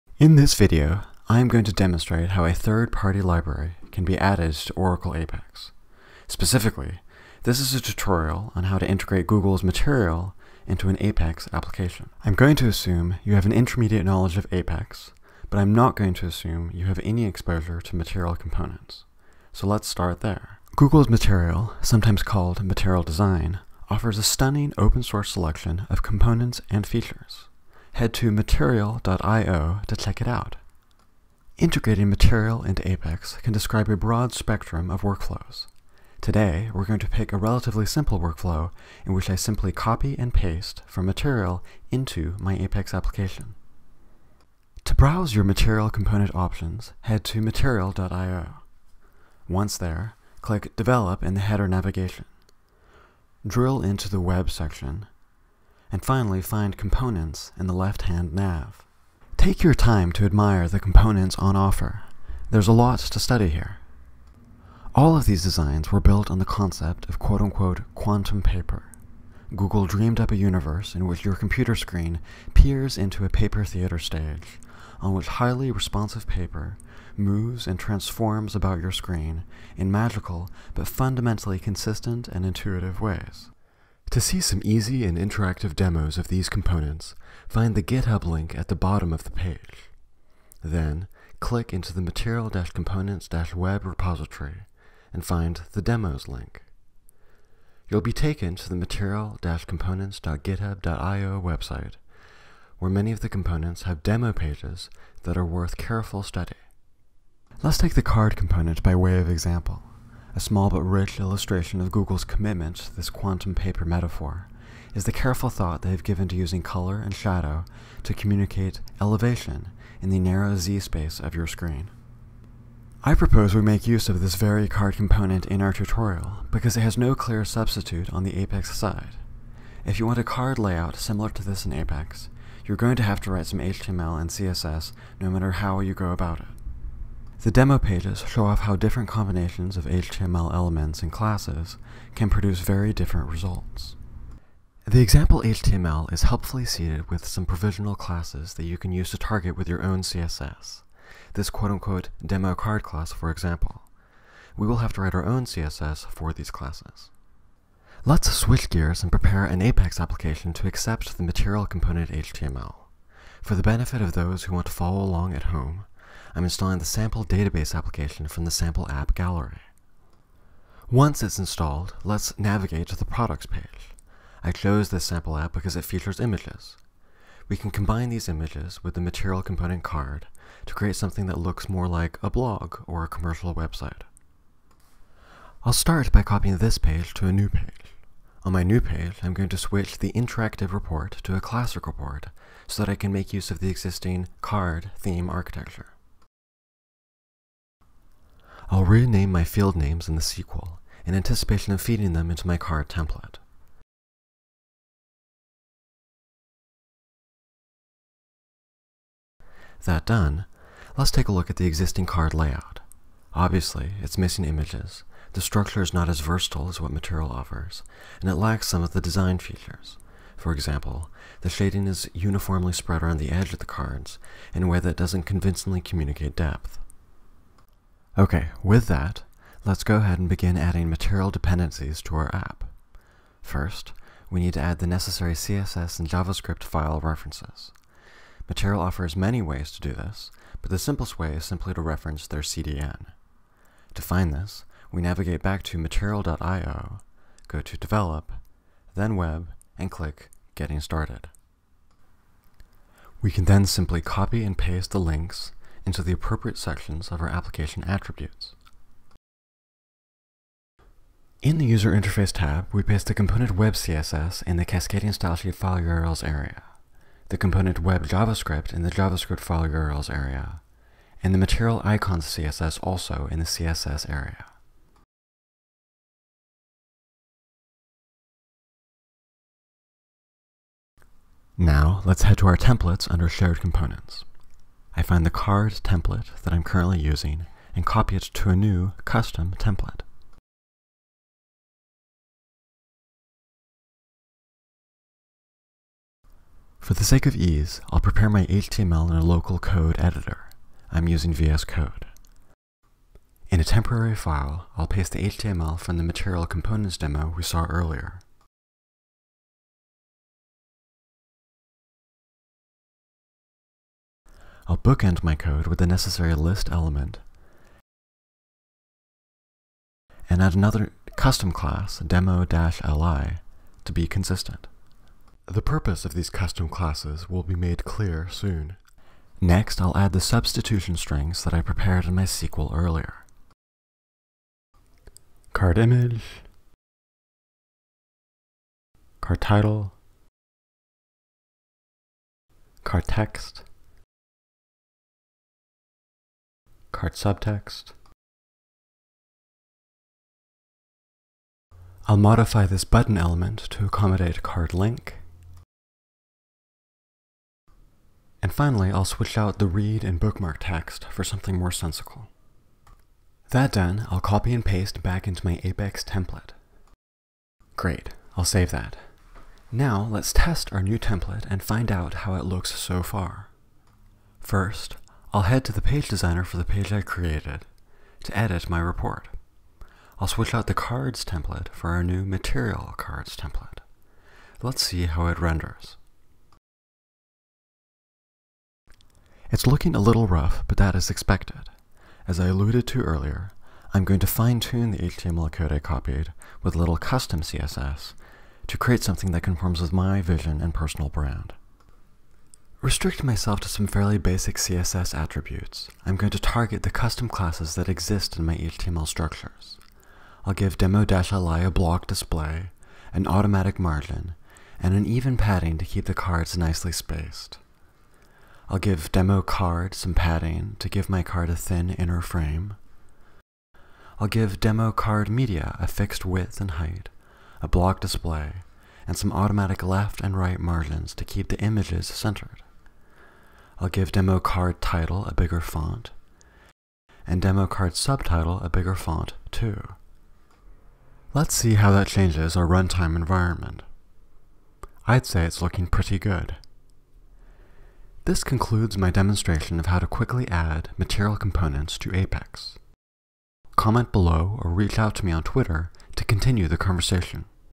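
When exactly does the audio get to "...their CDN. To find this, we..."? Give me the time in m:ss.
4:02.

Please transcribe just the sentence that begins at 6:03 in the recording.
That done, I'll copy and paste back into my Apex template.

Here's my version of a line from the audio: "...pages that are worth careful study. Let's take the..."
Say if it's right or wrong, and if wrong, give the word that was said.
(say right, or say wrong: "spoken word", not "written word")
right.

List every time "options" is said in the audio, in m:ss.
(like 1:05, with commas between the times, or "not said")
0:46.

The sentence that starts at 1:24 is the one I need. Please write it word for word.
To see some easy and interactive demos of these components, find the GitHub link at the bottom of the page.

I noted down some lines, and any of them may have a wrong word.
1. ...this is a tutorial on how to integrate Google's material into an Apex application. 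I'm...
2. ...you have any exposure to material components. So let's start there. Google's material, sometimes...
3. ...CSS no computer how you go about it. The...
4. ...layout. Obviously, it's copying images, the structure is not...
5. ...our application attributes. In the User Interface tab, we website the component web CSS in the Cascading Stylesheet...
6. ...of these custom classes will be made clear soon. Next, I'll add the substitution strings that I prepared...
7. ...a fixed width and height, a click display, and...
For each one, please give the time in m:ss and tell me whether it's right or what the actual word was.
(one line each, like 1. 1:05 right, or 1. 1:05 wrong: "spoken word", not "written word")
1. 0:07 right
2. 0:16 right
3. 2:14 wrong: "matter", not "computer"
4. 3:32 wrong: "missing", not "copying"
5. 4:17 wrong: "paste", not "website"
6. 5:26 right
7. 7:05 wrong: "block", not "click".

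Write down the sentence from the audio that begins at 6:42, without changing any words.
Restrict myself to some fairly basic CSS attributes.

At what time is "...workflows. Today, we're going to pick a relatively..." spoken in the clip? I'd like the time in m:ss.
0:35.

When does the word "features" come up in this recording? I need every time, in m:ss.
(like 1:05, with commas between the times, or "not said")
0:26, 2:55, 3:39.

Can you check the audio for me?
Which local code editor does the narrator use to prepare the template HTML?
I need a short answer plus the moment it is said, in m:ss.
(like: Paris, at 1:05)
VS Code, at 5:01.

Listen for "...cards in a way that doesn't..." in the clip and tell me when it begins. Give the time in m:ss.
3:43.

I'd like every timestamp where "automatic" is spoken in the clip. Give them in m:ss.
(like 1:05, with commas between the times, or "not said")
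6:53, 7:09.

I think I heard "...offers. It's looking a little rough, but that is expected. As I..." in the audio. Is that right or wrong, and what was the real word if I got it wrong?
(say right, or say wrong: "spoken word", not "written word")
wrong: "renders", not "offers".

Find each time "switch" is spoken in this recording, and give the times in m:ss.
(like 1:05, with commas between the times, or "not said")
2:38, 3:09, 5:59, 6:20.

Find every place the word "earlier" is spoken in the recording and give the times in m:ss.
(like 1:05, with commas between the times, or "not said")
5:07, 5:32, 6:33.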